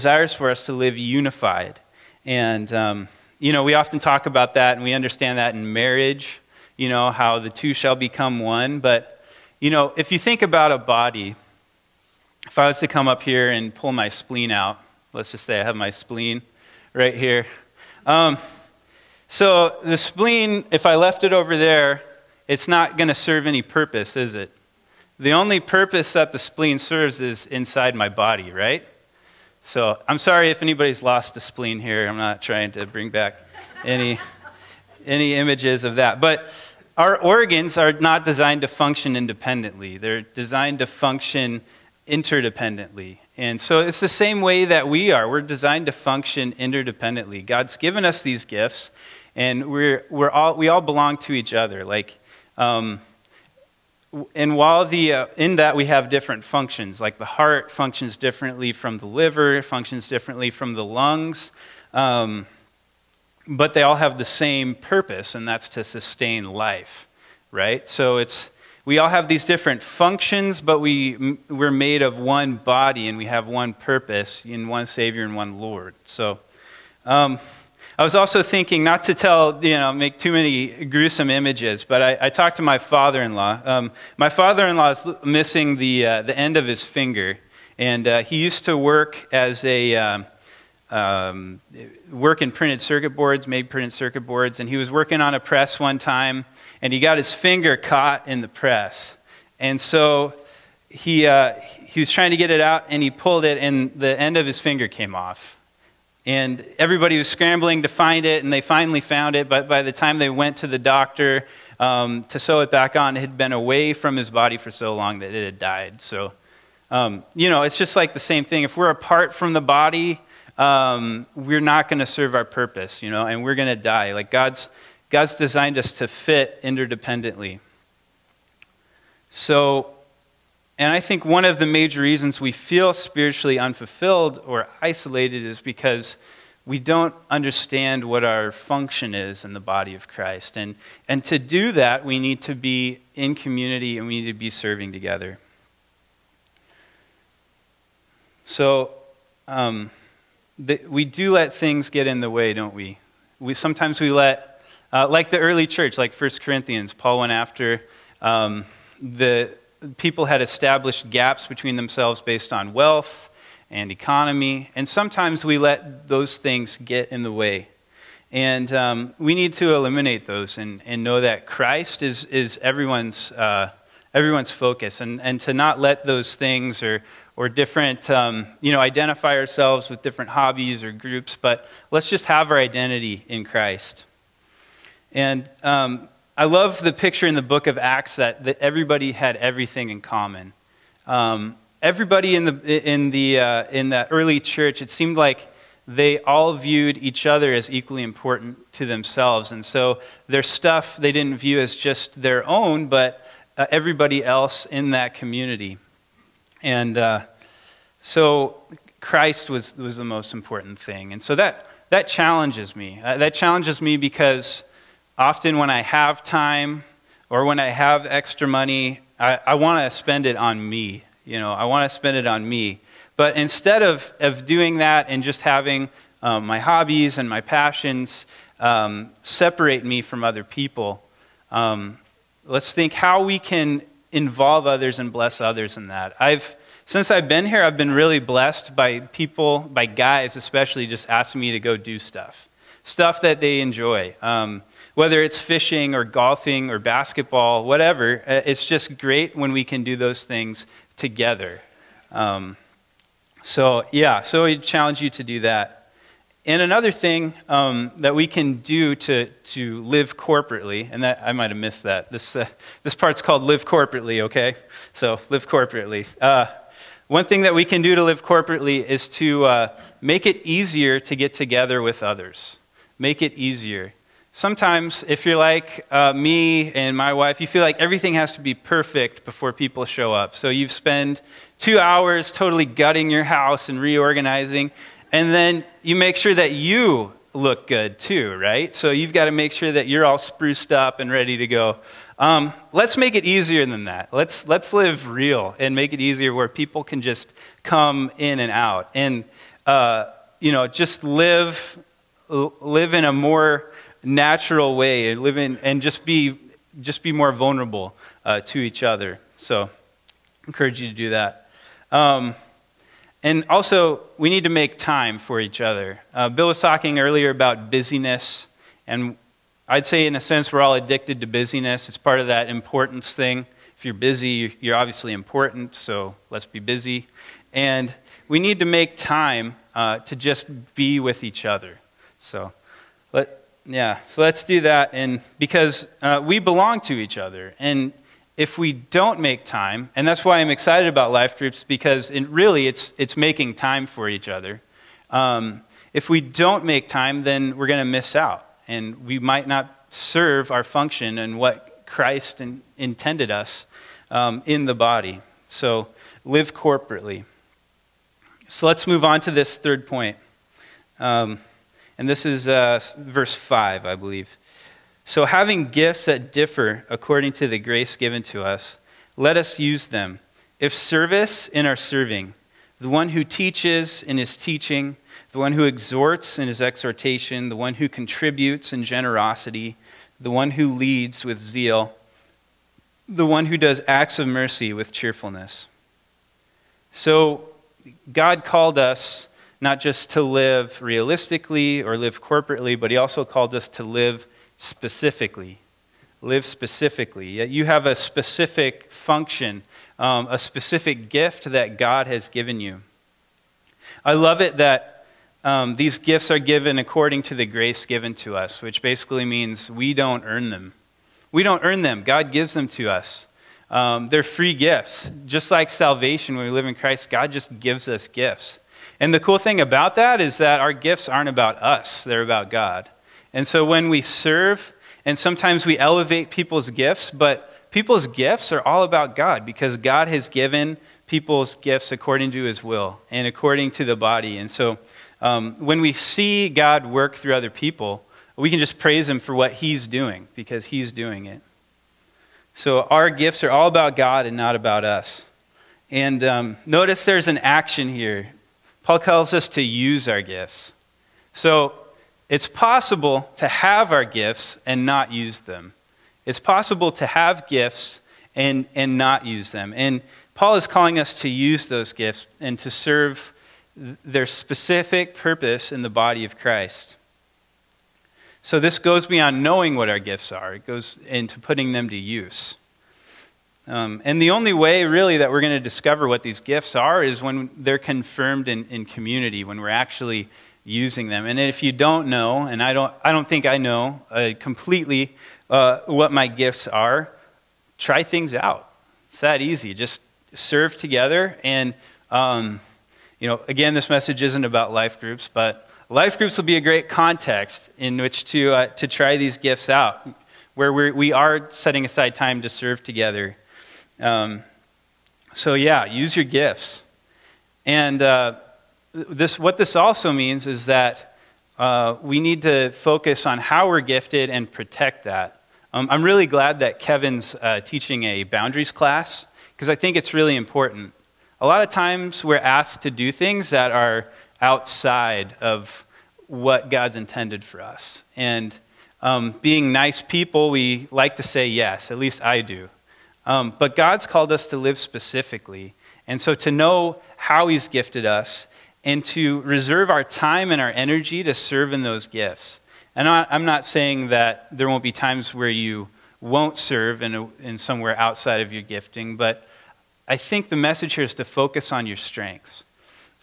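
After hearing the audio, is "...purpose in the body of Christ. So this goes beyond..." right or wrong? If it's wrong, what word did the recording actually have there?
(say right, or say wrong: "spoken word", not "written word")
right.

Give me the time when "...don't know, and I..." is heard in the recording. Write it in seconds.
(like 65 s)
481 s.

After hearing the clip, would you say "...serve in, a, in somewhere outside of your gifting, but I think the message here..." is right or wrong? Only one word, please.
right.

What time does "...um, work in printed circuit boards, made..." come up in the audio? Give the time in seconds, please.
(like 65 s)
90 s.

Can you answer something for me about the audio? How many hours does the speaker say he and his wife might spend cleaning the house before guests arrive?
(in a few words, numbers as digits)
2.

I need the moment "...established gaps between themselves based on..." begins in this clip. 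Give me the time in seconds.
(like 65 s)
160 s.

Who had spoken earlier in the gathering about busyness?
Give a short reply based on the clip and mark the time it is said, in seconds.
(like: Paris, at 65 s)
Bill, at 316 s.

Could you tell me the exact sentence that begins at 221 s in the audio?
You know, I want to spend it on me.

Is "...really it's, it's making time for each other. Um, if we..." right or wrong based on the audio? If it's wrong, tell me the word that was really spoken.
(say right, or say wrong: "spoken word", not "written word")
right.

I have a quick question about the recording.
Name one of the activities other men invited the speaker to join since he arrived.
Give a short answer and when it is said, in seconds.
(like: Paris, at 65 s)
fishing, at 245 s.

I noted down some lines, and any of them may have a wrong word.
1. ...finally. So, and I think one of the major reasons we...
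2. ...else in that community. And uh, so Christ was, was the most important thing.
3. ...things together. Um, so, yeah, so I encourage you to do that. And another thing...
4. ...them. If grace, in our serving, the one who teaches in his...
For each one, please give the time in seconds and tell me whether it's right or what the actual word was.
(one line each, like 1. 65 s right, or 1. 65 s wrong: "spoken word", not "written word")
1. 126 s wrong: "interdependently", not "finally"
2. 204 s right
3. 250 s wrong: "challenge", not "encourage"
4. 369 s wrong: "service", not "grace".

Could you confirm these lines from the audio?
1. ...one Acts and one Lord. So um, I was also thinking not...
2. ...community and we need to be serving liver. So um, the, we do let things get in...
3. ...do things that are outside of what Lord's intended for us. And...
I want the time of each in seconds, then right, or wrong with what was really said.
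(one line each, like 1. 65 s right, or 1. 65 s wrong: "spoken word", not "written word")
1. 74 s wrong: "Savior", not "Acts"
2. 143 s wrong: "together", not "liver"
3. 522 s wrong: "God", not "Lord".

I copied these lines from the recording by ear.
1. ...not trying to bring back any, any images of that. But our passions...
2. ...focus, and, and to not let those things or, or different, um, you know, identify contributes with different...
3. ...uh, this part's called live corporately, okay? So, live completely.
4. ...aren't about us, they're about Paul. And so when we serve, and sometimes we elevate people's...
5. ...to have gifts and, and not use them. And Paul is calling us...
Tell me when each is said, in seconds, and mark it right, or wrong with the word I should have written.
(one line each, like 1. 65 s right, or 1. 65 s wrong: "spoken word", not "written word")
1. 32 s wrong: "organs", not "passions"
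2. 174 s wrong: "ourselves", not "contributes"
3. 262 s wrong: "corporately", not "completely"
4. 421 s wrong: "God", not "Paul"
5. 456 s right.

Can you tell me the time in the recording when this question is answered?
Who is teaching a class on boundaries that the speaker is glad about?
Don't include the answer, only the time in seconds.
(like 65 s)
516 s.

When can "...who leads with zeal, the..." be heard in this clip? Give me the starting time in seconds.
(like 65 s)
380 s.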